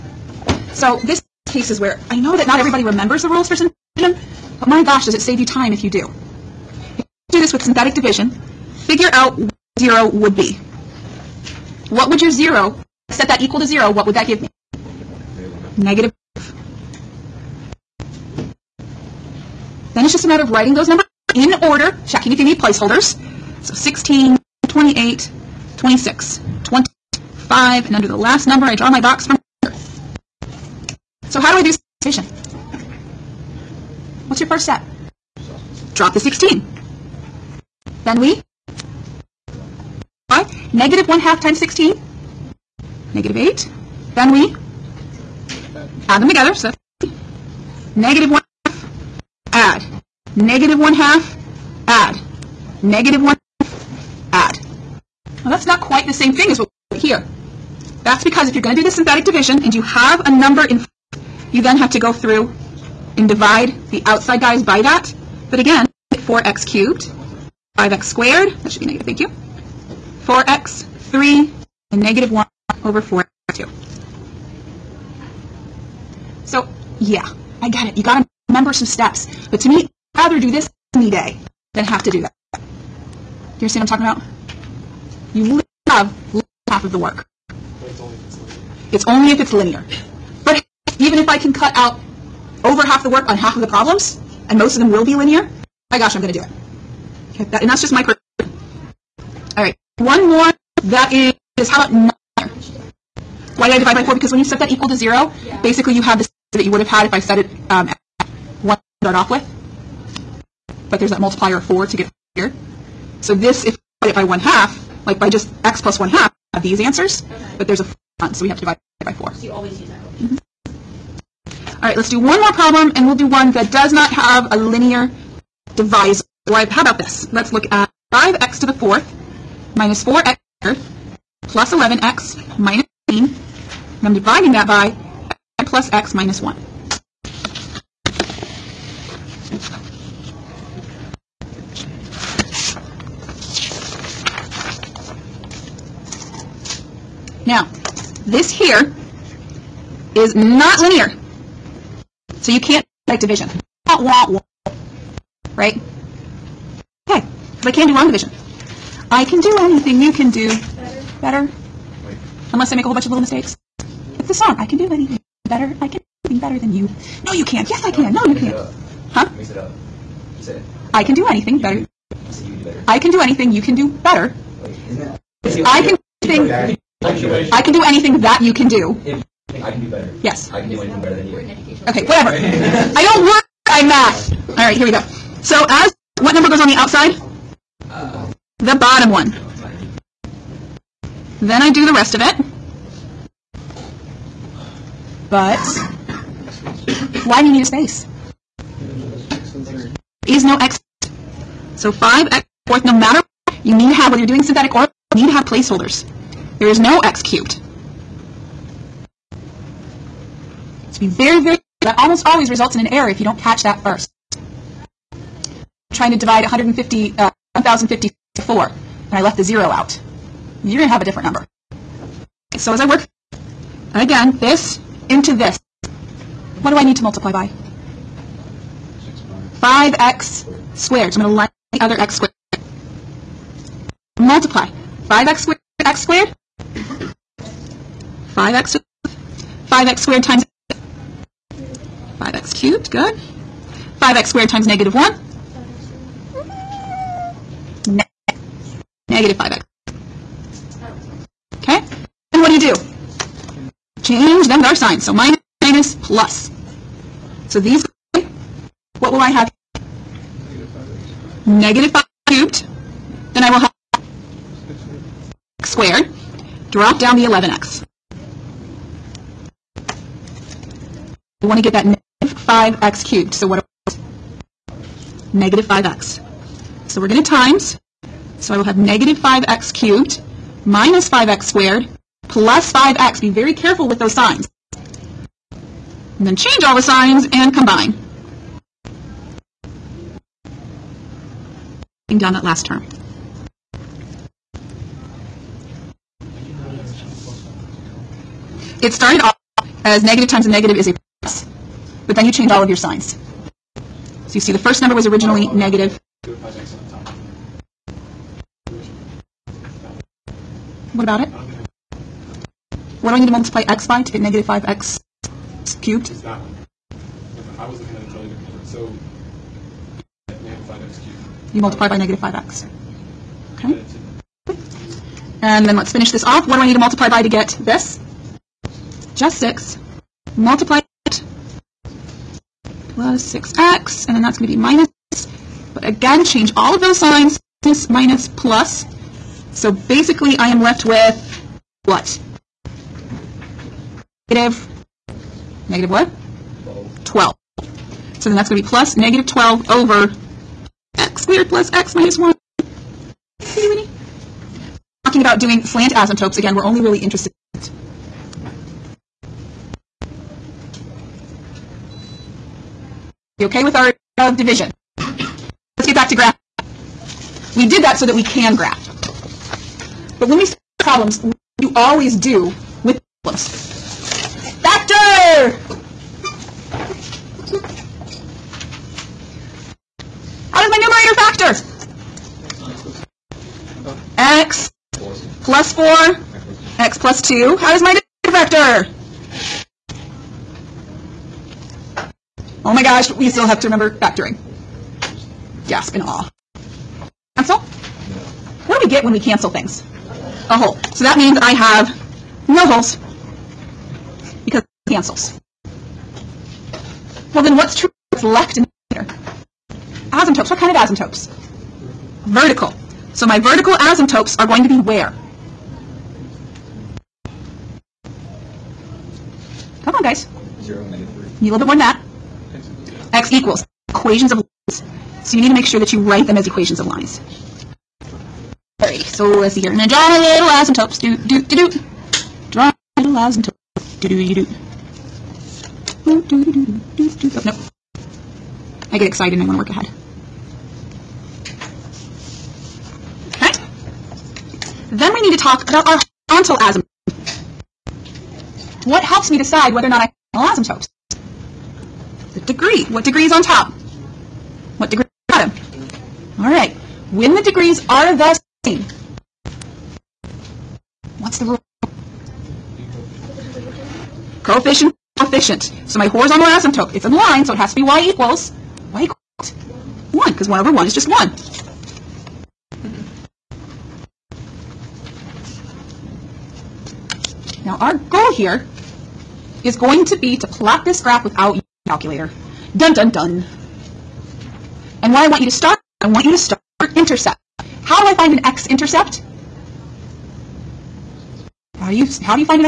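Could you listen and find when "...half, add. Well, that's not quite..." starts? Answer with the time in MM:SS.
00:53.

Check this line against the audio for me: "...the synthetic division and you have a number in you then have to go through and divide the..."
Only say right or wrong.
right.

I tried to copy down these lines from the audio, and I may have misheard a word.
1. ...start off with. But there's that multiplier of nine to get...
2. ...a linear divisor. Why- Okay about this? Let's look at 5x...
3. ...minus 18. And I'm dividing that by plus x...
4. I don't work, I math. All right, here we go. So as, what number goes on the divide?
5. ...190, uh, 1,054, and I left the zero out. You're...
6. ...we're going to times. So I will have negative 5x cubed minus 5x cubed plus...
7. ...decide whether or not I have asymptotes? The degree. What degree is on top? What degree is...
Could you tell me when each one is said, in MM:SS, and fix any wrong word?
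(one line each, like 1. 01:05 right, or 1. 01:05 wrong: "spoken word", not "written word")
1. 01:49 wrong: "four", not "nine"
2. 02:04 wrong: "How", not "Okay"
3. 02:12 right
4. 03:02 wrong: "outside", not "divide"
5. 03:36 wrong: "150", not "190"
6. 04:36 wrong: "squared", not "cubed"
7. 07:29 right.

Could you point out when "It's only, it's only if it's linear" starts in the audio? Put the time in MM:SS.
01:27.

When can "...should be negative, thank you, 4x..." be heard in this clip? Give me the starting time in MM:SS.
01:08.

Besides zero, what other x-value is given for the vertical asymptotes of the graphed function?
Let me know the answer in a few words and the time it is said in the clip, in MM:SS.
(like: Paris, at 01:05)
-3, at 07:00.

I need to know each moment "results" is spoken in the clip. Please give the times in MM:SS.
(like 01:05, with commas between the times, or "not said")
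03:32.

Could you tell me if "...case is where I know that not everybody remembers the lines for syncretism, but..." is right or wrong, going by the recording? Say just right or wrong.
wrong.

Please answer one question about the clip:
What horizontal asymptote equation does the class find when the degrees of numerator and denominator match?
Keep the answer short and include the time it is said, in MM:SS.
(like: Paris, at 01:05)
y = 1, at 07:48.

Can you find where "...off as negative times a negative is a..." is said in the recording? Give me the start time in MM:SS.
04:59.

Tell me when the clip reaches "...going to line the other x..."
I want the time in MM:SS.
03:51.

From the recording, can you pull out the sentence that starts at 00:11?
What would your zero, set that equal to zero, what would that give me?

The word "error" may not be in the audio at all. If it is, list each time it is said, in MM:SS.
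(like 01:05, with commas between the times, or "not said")
03:32.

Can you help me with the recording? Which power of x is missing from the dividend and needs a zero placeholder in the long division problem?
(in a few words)
x cubed.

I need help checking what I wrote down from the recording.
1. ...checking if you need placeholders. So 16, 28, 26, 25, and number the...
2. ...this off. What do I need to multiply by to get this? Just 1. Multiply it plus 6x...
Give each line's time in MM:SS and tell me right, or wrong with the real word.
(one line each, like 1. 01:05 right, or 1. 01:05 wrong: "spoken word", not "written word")
1. 00:22 wrong: "under", not "number"
2. 05:26 wrong: "6", not "1".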